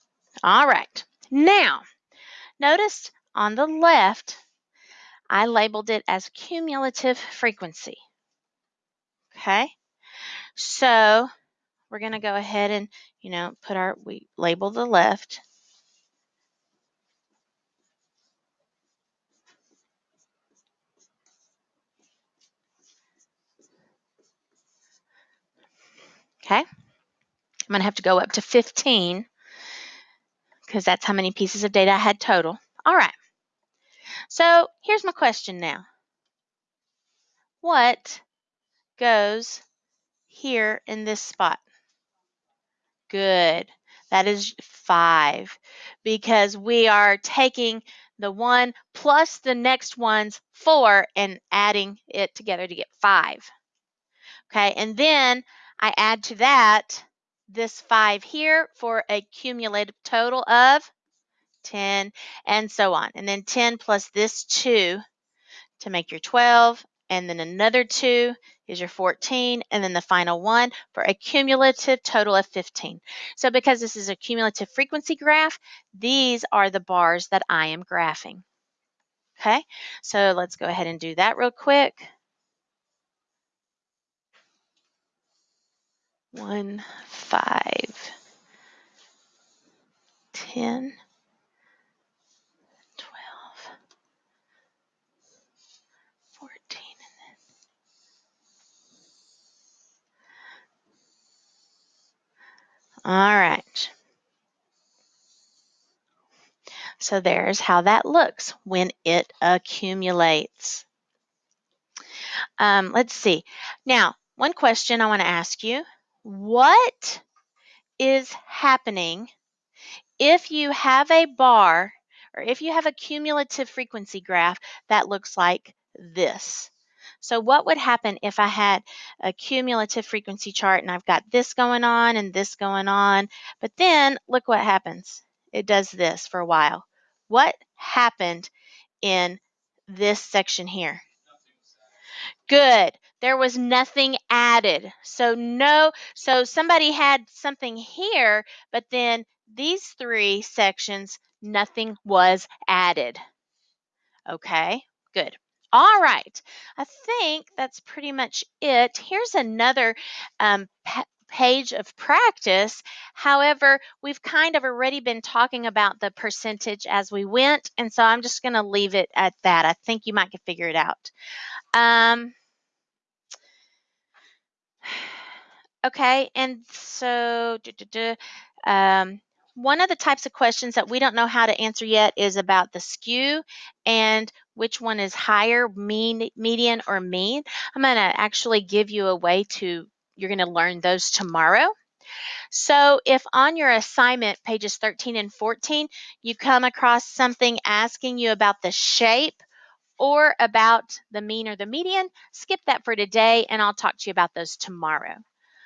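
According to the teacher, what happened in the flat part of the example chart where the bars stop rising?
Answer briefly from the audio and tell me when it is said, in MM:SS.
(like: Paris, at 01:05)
Nothing was added, at 02:31.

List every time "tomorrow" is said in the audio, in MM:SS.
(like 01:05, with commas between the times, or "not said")
03:11, 03:24.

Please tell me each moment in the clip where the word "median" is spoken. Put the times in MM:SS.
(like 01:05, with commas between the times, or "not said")
03:06, 03:21.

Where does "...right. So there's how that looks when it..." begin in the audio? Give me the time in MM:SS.
01:43.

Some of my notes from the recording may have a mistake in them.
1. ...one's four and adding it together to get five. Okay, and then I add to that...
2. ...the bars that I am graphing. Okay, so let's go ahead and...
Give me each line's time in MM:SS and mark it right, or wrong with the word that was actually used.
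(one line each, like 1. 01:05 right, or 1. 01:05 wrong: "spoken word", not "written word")
1. 00:49 right
2. 01:16 right.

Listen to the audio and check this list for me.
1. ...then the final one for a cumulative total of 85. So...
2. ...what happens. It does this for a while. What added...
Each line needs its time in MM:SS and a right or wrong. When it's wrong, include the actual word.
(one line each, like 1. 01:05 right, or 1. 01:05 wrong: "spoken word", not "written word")
1. 01:09 wrong: "15", not "85"
2. 02:14 wrong: "happened", not "added".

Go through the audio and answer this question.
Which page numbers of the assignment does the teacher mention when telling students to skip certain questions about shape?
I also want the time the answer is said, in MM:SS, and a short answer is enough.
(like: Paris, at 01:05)
13 and 14, at 03:14.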